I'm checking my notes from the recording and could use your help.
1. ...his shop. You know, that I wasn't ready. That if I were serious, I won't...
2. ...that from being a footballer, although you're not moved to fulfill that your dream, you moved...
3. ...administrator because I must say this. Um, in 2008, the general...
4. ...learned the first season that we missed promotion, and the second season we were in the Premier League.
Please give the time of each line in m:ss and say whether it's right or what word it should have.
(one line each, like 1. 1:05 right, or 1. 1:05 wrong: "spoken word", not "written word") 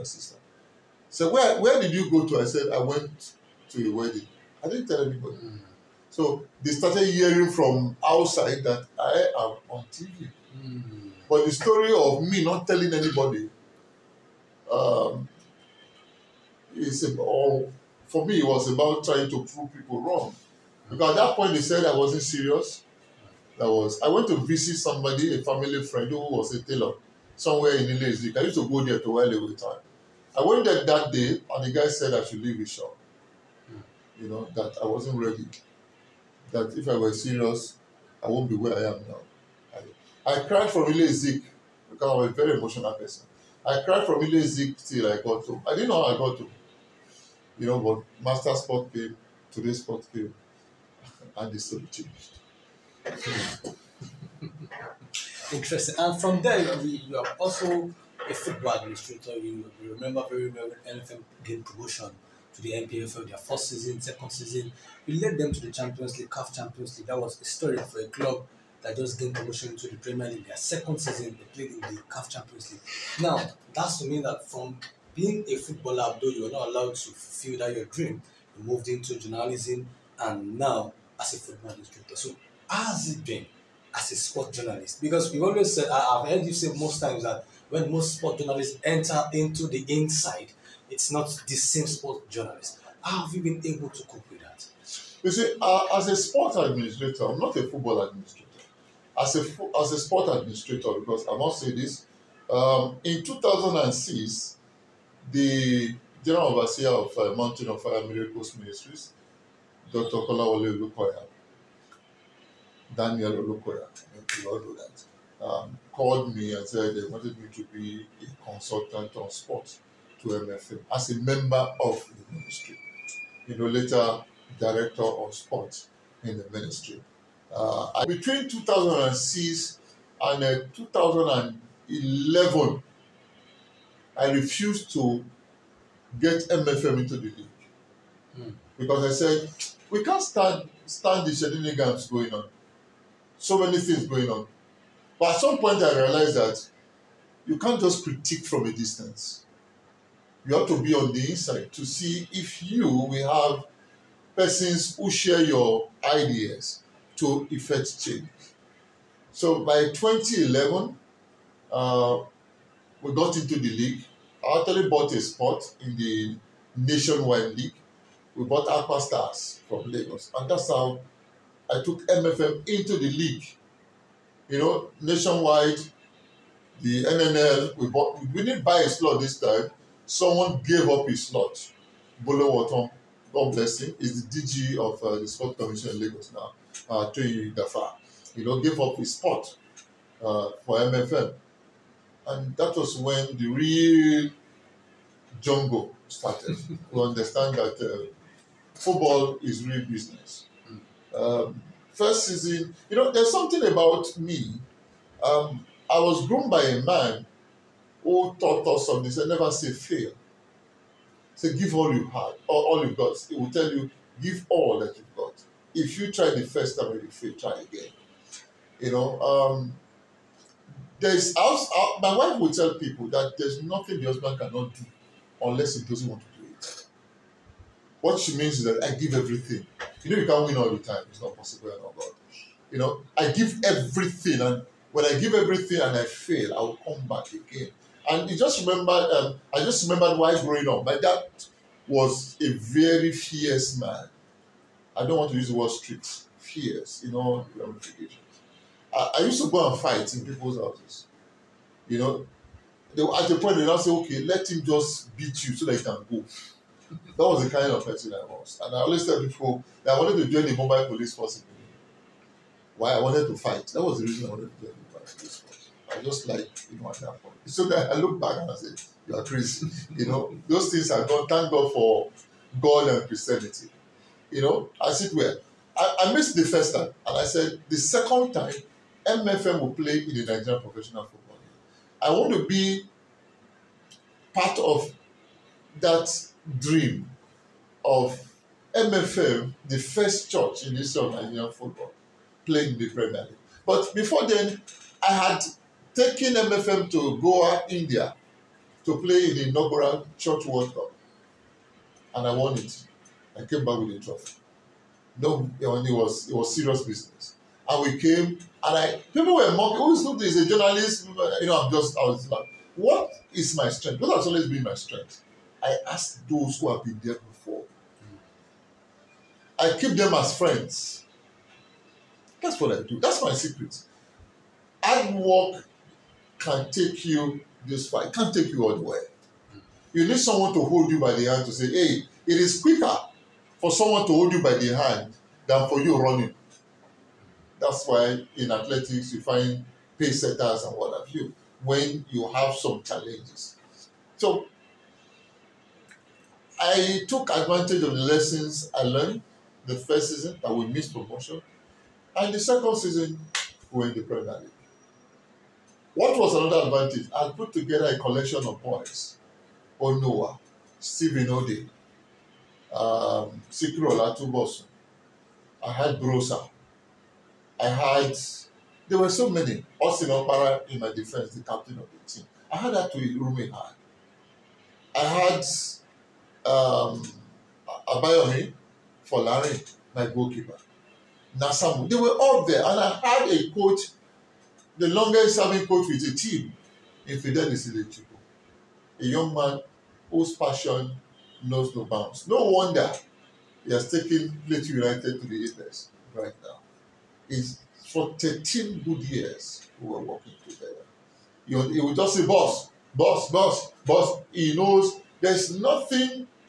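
1. 0:32 right
2. 1:14 wrong: "allowed", not "moved"
3. 1:40 wrong: "2006", not "2008"
4. 5:48 right.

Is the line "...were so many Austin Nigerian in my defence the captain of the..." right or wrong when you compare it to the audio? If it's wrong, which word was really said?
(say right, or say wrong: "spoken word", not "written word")
wrong: "Okpara", not "Nigerian".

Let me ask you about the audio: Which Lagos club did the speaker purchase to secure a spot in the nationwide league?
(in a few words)
Aqua Stars.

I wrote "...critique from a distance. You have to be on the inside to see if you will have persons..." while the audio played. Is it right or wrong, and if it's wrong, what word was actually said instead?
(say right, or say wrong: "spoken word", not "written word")
right.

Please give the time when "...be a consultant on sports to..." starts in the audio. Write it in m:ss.
1:57.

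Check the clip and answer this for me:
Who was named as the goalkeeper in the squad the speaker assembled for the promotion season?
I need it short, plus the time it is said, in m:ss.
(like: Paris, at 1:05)
Abayomi Larry, at 6:17.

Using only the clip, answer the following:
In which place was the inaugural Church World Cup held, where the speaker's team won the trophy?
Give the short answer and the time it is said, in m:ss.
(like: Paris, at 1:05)
Goa, India, at 4:57.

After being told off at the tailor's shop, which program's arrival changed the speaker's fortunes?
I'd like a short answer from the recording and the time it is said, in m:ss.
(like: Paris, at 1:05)
Master Sport, at 0:48.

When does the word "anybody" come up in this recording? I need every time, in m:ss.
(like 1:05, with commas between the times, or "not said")
0:05, 0:12.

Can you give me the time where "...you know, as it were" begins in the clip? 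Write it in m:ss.
4:34.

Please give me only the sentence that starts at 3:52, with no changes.
You know, I give everything, and when I give everything and I fail, I will come back again.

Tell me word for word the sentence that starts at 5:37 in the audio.
That's why in athletics you find pace setters and what have you when you have some challenges.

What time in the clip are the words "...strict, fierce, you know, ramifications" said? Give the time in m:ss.
4:05.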